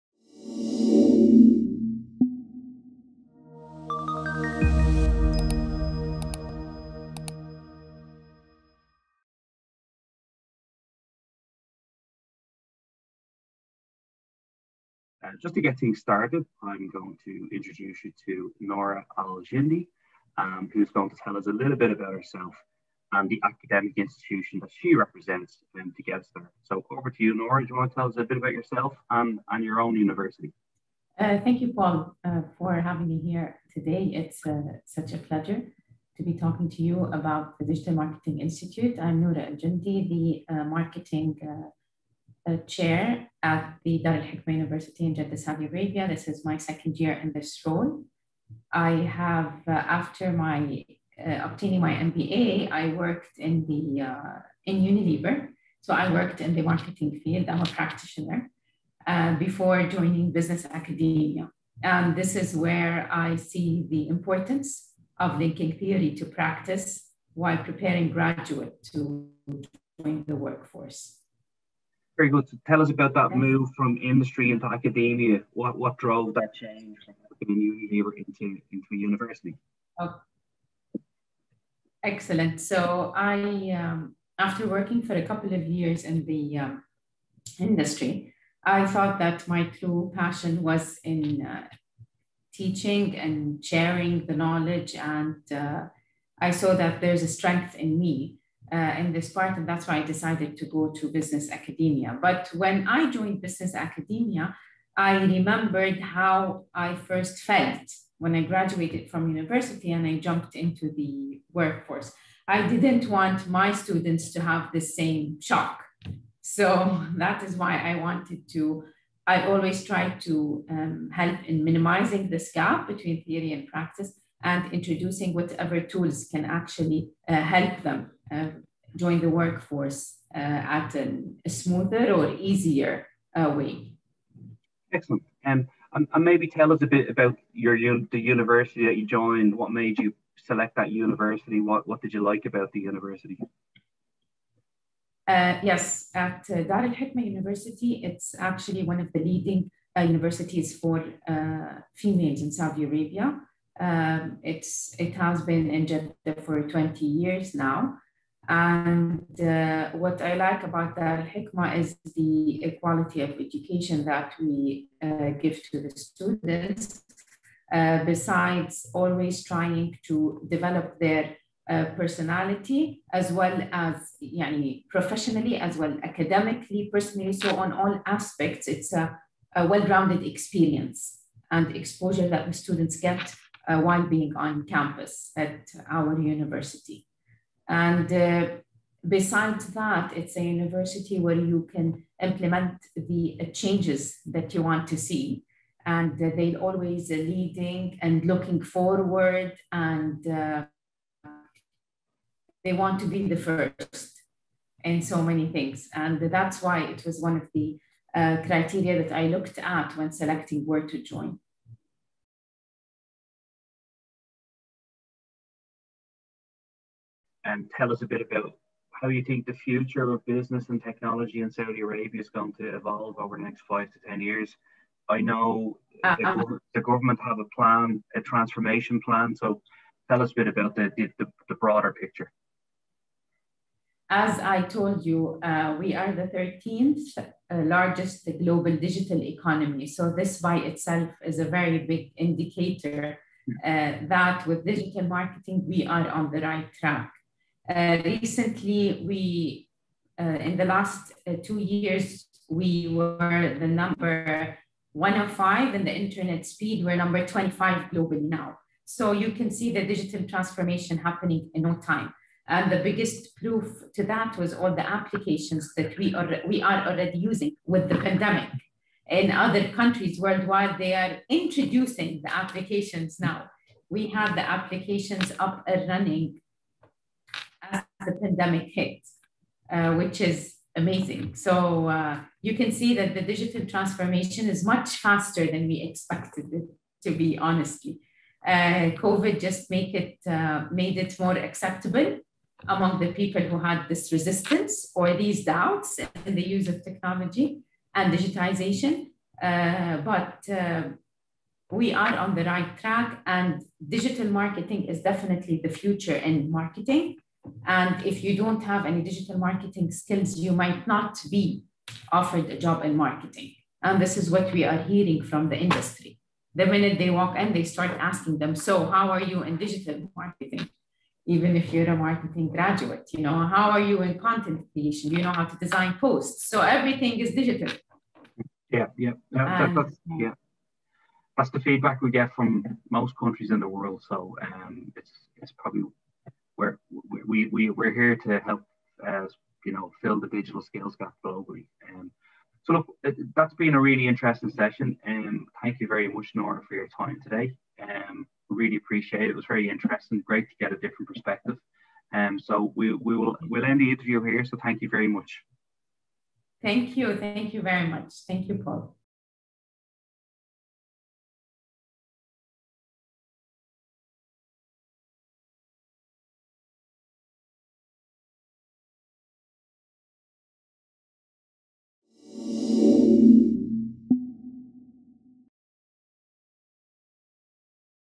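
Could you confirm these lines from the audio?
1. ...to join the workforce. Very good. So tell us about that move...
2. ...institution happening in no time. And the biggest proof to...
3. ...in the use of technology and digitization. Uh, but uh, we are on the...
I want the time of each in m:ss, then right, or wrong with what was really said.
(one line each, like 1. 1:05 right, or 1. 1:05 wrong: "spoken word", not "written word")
1. 1:08 right
2. 4:20 wrong: "transformation", not "institution"
3. 4:56 right.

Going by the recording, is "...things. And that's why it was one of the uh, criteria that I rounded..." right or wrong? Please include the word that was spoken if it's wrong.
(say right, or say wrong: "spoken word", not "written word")
wrong: "looked", not "rounded".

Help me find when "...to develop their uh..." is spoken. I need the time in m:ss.
2:50.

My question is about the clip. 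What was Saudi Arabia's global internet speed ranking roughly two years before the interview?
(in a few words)
105.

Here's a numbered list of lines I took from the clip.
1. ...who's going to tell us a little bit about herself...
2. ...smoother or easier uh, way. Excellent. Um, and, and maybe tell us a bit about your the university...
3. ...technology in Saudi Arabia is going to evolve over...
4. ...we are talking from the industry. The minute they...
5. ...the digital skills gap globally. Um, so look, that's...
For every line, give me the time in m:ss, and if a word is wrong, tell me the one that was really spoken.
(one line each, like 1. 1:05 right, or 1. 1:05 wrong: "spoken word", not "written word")
1. 0:20 right
2. 2:11 right
3. 3:40 right
4. 5:14 wrong: "hearing", not "talking"
5. 5:40 right.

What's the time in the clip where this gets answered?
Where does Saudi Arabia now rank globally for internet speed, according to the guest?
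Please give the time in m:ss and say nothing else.
4:17.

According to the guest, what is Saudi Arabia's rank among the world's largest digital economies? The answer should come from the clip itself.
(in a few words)
13th.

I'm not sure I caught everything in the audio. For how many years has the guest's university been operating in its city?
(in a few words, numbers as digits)
20 years.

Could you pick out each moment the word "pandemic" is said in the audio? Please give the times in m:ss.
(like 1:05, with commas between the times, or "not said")
4:27, 4:38.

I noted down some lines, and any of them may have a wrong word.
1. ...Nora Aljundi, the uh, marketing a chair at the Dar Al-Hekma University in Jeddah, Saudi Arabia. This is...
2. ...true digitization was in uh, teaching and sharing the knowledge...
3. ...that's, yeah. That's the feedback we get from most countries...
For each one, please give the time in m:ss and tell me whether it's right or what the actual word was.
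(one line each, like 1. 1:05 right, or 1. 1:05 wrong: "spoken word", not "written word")
1. 0:39 right
2. 1:29 wrong: "passion", not "digitization"
3. 5:29 right.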